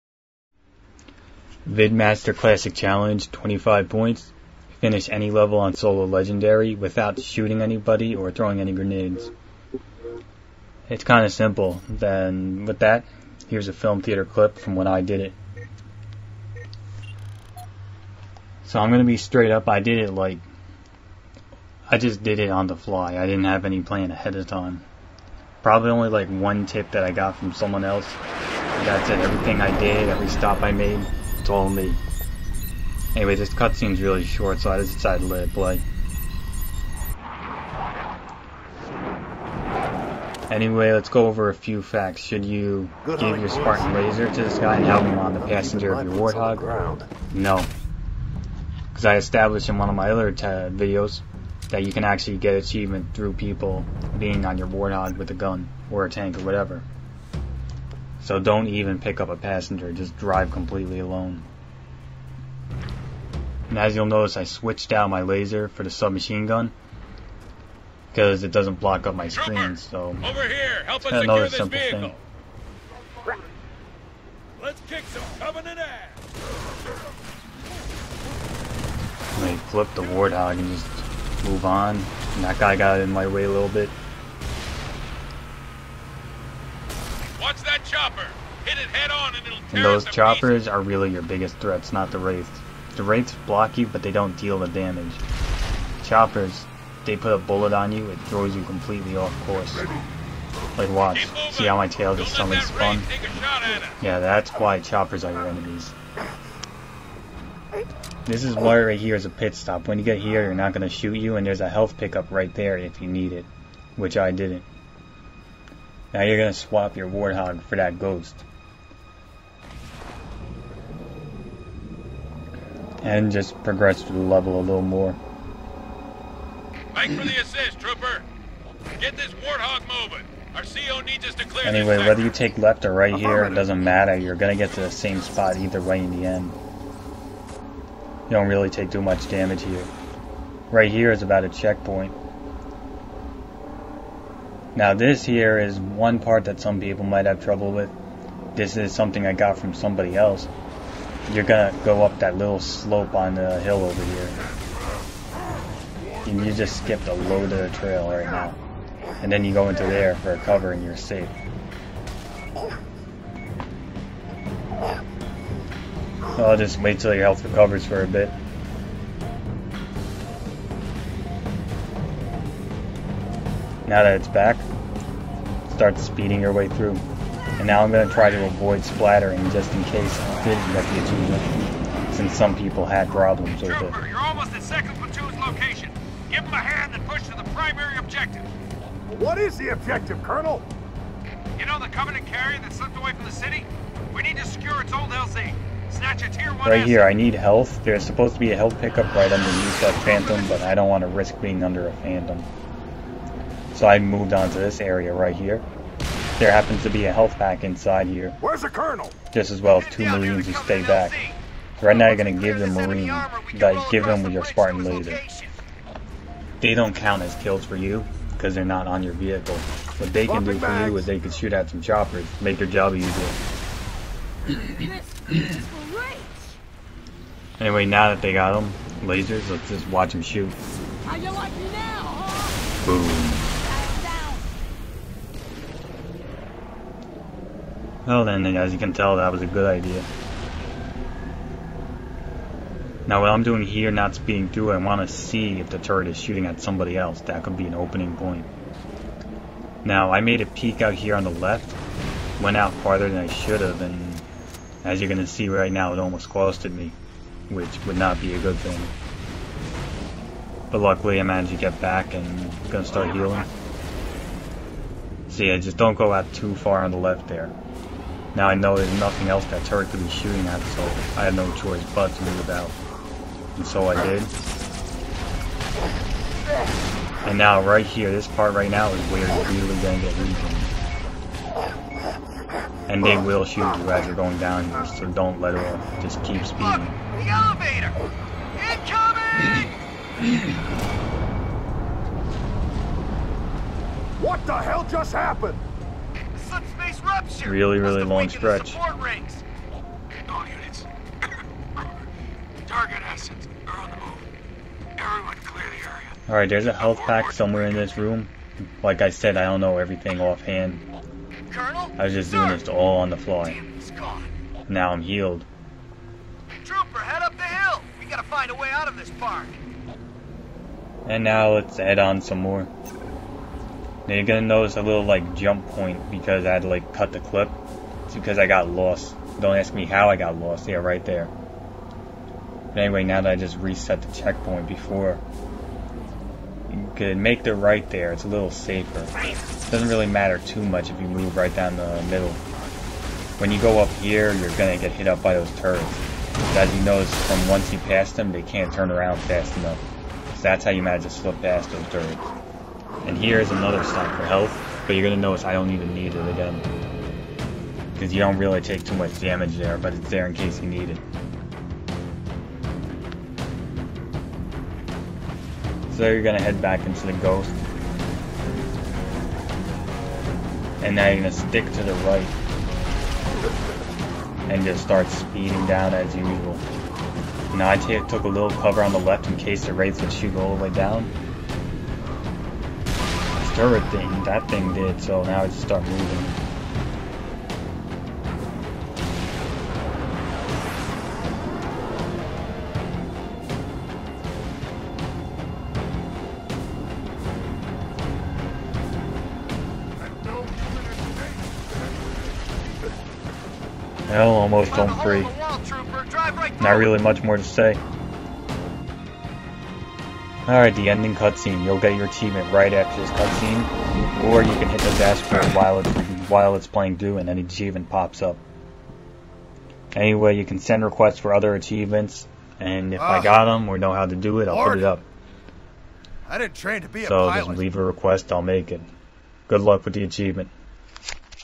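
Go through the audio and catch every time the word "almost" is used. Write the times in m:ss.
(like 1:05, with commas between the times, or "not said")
3:04, 4:15, 6:44.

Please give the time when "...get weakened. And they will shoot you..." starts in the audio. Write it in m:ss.
4:39.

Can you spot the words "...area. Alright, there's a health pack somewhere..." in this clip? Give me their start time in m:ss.
5:05.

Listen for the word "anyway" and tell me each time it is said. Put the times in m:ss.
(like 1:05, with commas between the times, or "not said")
0:33, 0:40, 2:11, 3:47, 5:32, 6:59.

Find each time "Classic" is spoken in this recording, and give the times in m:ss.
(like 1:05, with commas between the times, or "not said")
0:02.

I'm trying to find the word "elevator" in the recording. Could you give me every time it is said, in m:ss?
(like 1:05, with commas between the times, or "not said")
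4:47.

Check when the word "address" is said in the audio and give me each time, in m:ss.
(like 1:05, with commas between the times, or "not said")
not said.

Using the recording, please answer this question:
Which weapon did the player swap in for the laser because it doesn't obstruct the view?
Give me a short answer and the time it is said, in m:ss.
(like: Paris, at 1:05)
submachine gun, at 1:05.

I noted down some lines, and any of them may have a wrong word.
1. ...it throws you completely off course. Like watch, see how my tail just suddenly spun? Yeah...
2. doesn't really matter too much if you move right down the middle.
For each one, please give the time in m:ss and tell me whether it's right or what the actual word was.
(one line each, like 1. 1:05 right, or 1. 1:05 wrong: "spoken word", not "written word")
1. 1:38 right
2. 5:39 right.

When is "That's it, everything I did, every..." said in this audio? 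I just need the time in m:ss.
0:28.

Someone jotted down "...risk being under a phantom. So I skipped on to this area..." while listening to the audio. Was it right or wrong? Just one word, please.
wrong.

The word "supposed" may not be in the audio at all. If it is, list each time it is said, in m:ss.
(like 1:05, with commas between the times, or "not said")
3:18.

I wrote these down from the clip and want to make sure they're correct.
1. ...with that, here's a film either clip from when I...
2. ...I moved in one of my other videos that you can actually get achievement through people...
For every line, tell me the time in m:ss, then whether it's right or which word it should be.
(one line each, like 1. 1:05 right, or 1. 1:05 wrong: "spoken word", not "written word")
1. 0:12 wrong: "theater", not "either"
2. 0:49 wrong: "established", not "moved".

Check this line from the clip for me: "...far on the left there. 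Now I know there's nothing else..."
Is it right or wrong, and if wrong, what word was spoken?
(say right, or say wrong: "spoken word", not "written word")
right.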